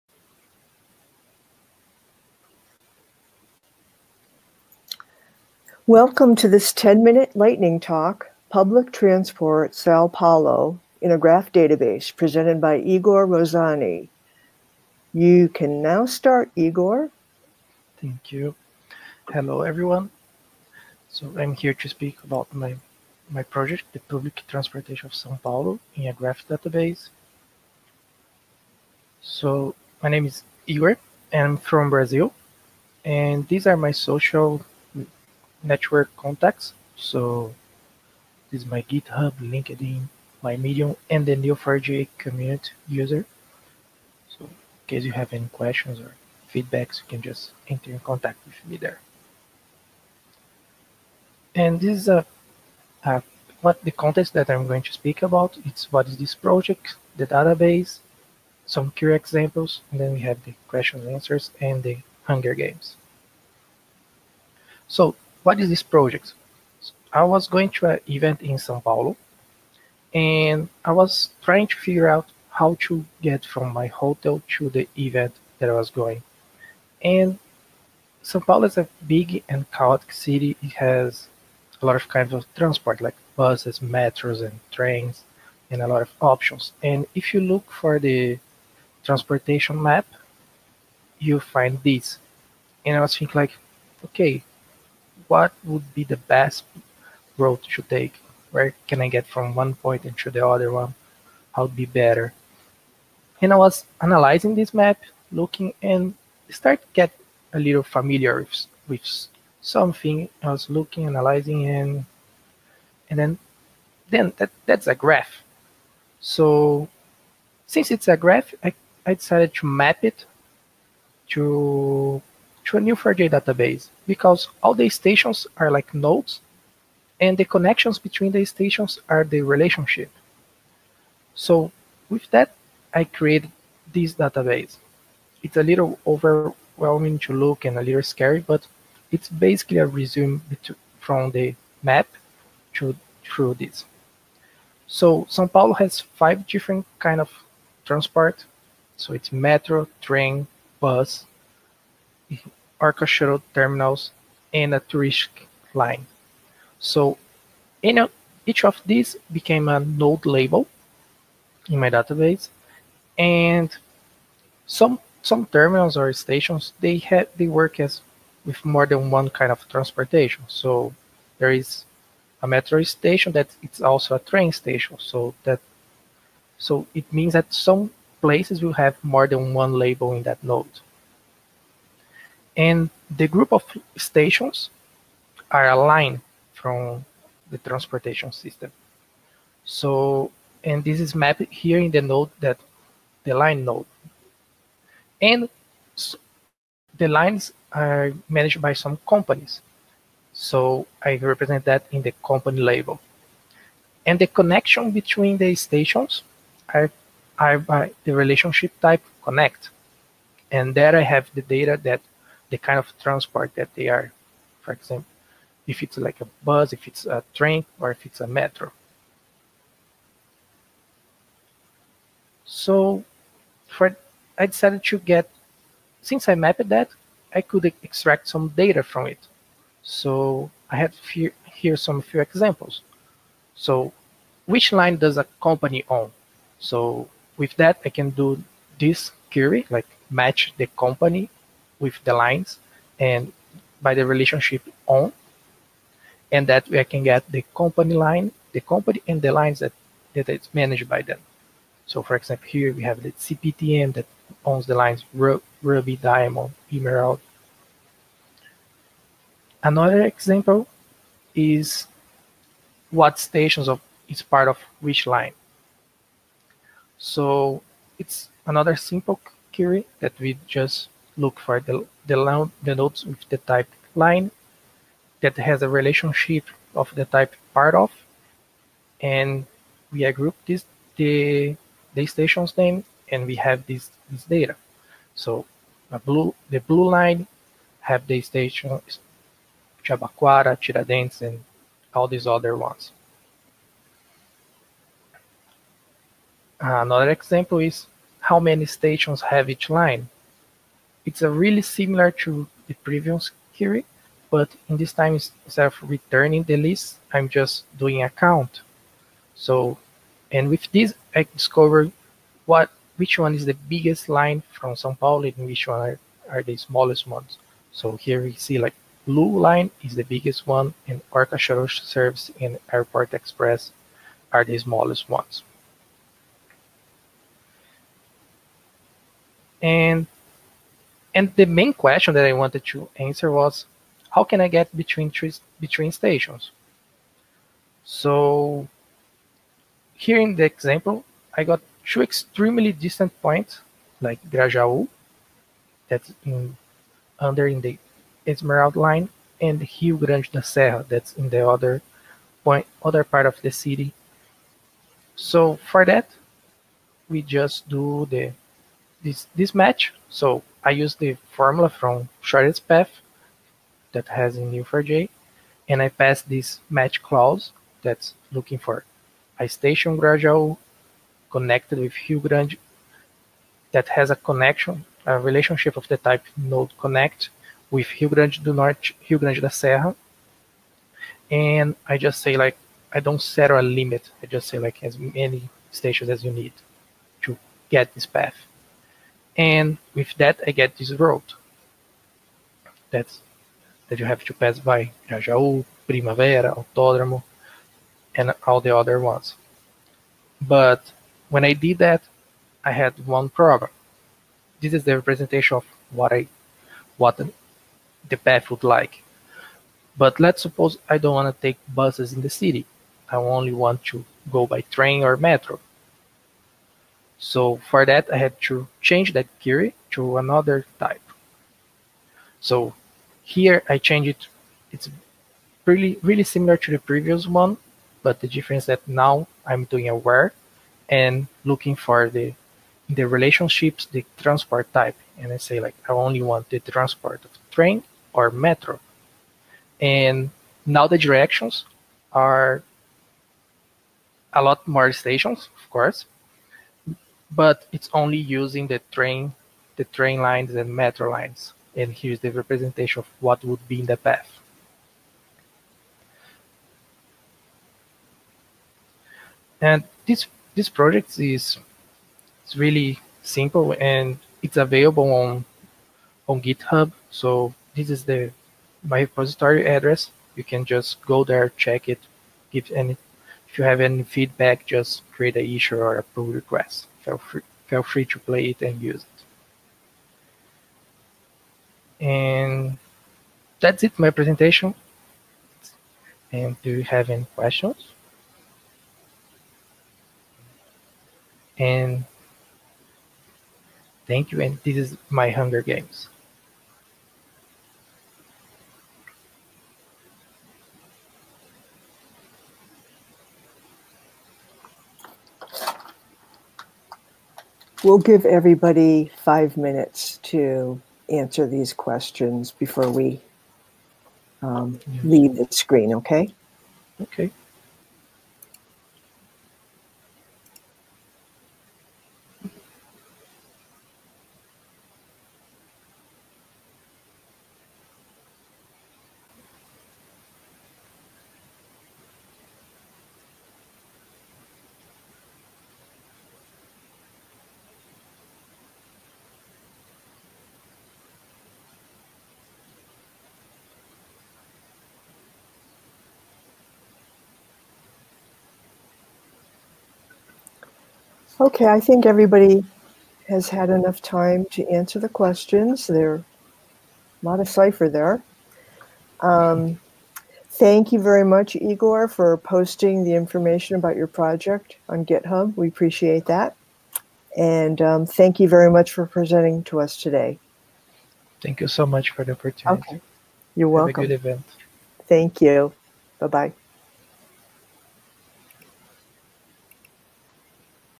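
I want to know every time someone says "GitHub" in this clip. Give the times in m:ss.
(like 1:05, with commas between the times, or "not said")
0:38, 7:46, 9:25.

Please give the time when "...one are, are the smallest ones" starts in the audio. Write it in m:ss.
5:15.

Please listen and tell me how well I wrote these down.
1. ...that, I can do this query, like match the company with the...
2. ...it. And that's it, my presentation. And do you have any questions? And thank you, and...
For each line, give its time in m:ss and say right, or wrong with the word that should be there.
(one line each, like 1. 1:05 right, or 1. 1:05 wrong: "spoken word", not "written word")
1. 3:57 right
2. 8:01 right.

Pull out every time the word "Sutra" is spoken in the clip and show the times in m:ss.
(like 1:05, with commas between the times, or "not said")
not said.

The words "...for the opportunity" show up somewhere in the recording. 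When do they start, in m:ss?
9:32.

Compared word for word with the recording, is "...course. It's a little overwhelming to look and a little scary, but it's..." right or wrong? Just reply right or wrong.
wrong.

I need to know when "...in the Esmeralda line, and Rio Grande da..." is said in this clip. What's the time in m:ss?
5:47.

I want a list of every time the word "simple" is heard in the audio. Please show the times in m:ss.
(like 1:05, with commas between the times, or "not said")
4:28, 7:43.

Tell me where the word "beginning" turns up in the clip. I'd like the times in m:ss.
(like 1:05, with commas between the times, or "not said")
not said.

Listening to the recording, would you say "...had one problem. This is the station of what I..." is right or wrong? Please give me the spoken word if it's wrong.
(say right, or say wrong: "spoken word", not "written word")
wrong: "representation", not "station".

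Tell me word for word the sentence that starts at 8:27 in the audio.
We'll give everybody five minutes to answer these questions before we um, leave the screen, okay?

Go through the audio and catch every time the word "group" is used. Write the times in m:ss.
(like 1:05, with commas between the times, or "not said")
3:03, 4:40.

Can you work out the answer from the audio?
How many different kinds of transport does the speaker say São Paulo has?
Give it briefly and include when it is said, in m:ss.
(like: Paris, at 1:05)
5, at 2:25.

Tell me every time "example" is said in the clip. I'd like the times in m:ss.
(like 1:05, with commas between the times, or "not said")
0:59, 3:34, 3:52, 4:12, 4:20, 4:57, 5:40.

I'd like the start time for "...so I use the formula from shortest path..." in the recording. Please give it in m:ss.
6:00.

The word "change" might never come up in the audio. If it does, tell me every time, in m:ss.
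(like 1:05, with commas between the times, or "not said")
6:58, 7:03.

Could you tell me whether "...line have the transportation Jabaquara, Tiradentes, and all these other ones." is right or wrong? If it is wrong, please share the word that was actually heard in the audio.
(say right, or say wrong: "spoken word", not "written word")
wrong: "station", not "transportation".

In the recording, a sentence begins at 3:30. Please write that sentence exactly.
And there I have the data that the kind of transport that they are.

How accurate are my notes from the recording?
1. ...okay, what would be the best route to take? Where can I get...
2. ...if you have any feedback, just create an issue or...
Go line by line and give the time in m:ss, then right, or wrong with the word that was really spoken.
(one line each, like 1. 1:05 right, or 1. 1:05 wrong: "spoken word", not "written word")
1. 1:34 right
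2. 7:53 right.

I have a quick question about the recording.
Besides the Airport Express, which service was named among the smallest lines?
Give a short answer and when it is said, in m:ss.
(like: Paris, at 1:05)
Orca Shuttle Service, at 5:21.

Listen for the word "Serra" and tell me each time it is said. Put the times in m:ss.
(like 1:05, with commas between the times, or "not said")
5:50, 6:19.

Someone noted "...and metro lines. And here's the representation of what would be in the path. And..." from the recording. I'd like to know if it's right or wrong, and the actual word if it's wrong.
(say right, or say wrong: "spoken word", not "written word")
right.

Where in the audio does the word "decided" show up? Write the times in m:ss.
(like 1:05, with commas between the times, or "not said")
1:59, 3:44.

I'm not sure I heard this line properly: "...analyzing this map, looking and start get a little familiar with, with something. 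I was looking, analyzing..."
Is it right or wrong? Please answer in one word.
right.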